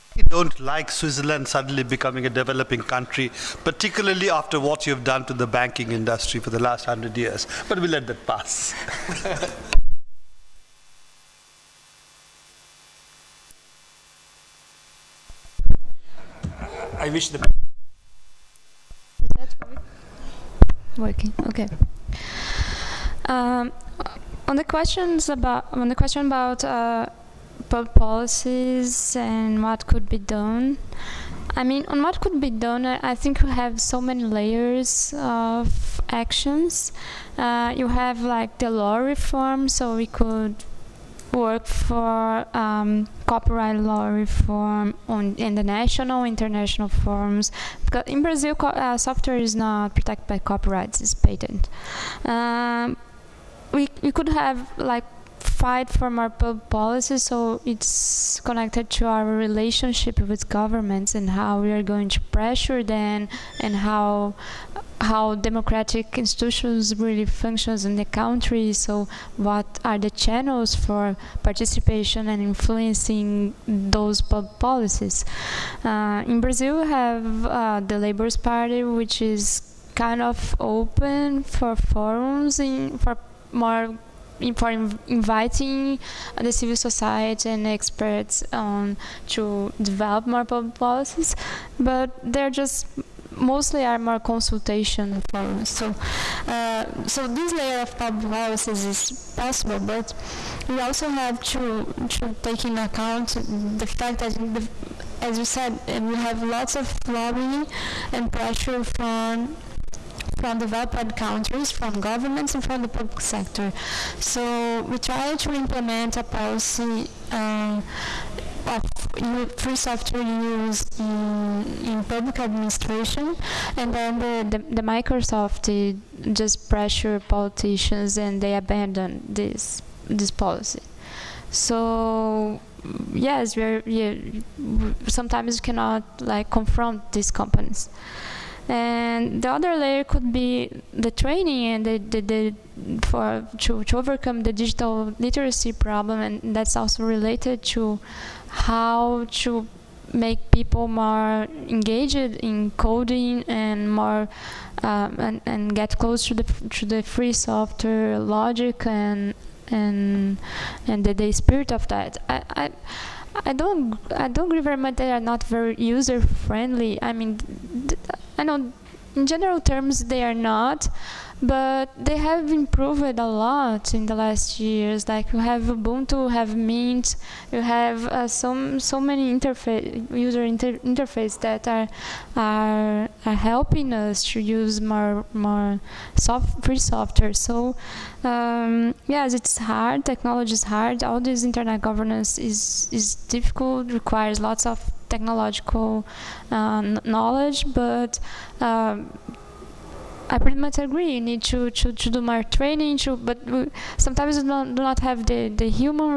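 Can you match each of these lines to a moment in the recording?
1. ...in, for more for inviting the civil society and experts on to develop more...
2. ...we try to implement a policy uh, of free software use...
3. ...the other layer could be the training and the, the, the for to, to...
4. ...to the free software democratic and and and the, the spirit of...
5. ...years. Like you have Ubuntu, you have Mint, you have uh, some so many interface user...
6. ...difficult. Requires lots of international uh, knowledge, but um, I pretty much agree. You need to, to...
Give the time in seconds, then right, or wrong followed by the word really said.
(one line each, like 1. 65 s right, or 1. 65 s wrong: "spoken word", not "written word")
1. 82 s right
2. 114 s right
3. 139 s right
4. 156 s wrong: "logic", not "democratic"
5. 174 s right
6. 193 s wrong: "technological", not "international".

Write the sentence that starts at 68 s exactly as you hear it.
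So what are the channels for participation and influencing those public policies?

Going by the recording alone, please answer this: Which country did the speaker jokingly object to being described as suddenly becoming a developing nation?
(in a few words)
Switzerland.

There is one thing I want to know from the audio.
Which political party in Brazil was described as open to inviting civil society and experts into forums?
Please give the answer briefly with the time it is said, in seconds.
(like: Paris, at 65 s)
Labor's Party, at 78 s.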